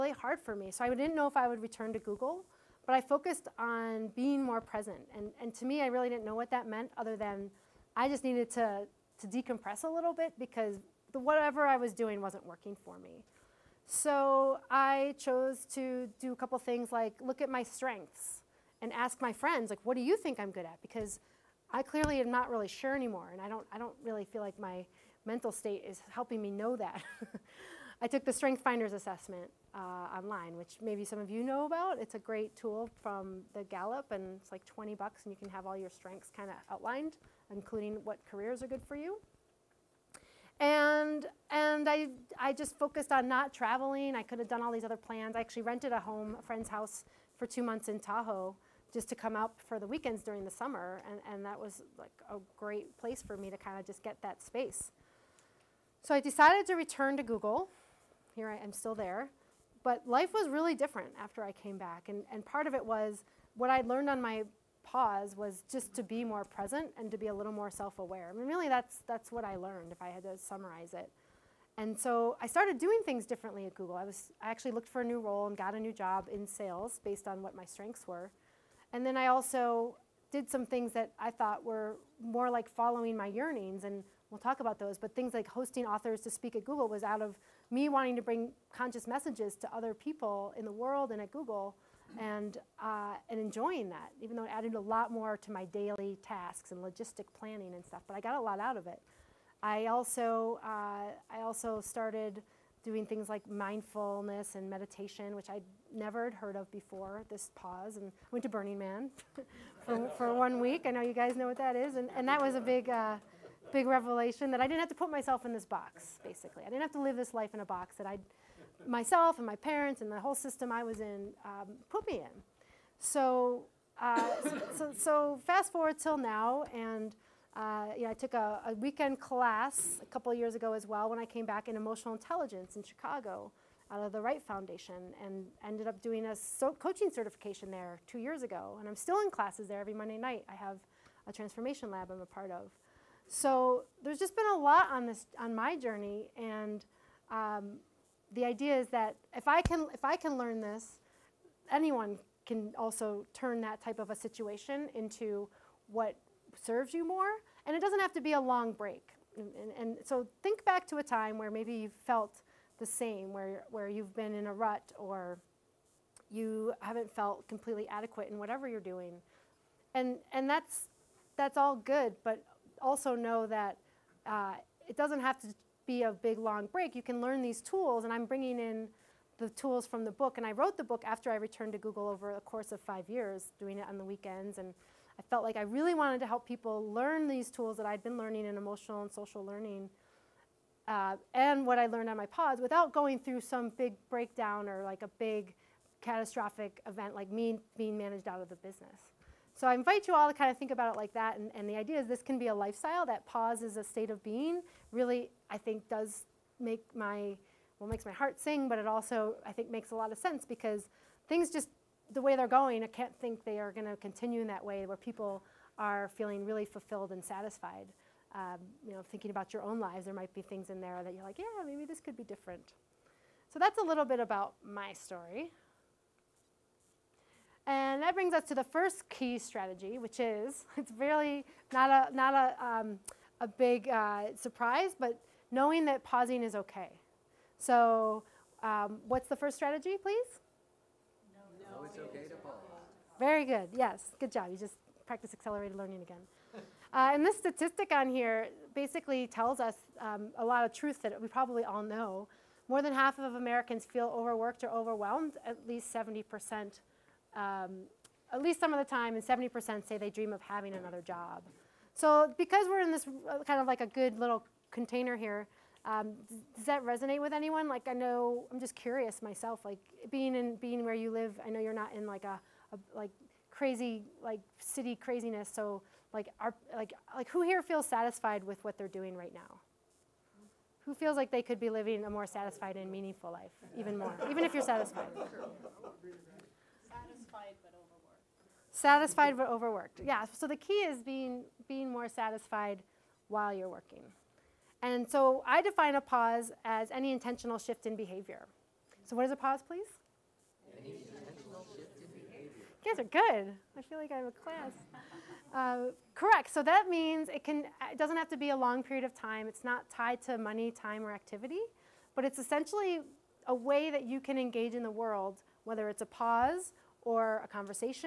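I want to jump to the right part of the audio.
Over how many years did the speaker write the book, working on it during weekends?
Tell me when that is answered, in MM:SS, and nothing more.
03:02.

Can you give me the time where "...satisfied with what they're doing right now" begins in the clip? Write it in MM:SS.
04:37.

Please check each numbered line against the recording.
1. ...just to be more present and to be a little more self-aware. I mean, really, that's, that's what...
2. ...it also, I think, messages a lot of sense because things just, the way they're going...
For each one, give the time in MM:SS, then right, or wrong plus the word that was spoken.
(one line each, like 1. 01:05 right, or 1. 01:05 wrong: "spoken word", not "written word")
1. 01:05 right
2. 03:28 wrong: "makes", not "messages".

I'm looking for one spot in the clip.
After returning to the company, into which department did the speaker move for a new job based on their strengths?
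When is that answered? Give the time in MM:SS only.
01:16.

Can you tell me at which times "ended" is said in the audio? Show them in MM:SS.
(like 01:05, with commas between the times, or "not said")
02:15.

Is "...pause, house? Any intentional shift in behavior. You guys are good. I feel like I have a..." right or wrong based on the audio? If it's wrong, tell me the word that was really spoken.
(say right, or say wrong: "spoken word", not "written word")
wrong: "please", not "house".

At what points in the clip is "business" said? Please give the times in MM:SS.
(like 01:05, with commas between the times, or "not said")
03:18.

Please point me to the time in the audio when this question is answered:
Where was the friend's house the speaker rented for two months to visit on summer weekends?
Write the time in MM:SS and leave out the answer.
00:47.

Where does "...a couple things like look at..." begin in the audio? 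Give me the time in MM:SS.
00:16.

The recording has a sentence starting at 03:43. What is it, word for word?
So that's a little bit about my story.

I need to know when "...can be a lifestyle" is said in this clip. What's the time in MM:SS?
03:22.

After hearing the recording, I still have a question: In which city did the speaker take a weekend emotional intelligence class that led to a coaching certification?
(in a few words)
Chicago.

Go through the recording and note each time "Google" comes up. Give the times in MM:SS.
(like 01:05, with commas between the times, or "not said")
00:01, 00:57, 01:13, 01:26, 01:31, 03:01.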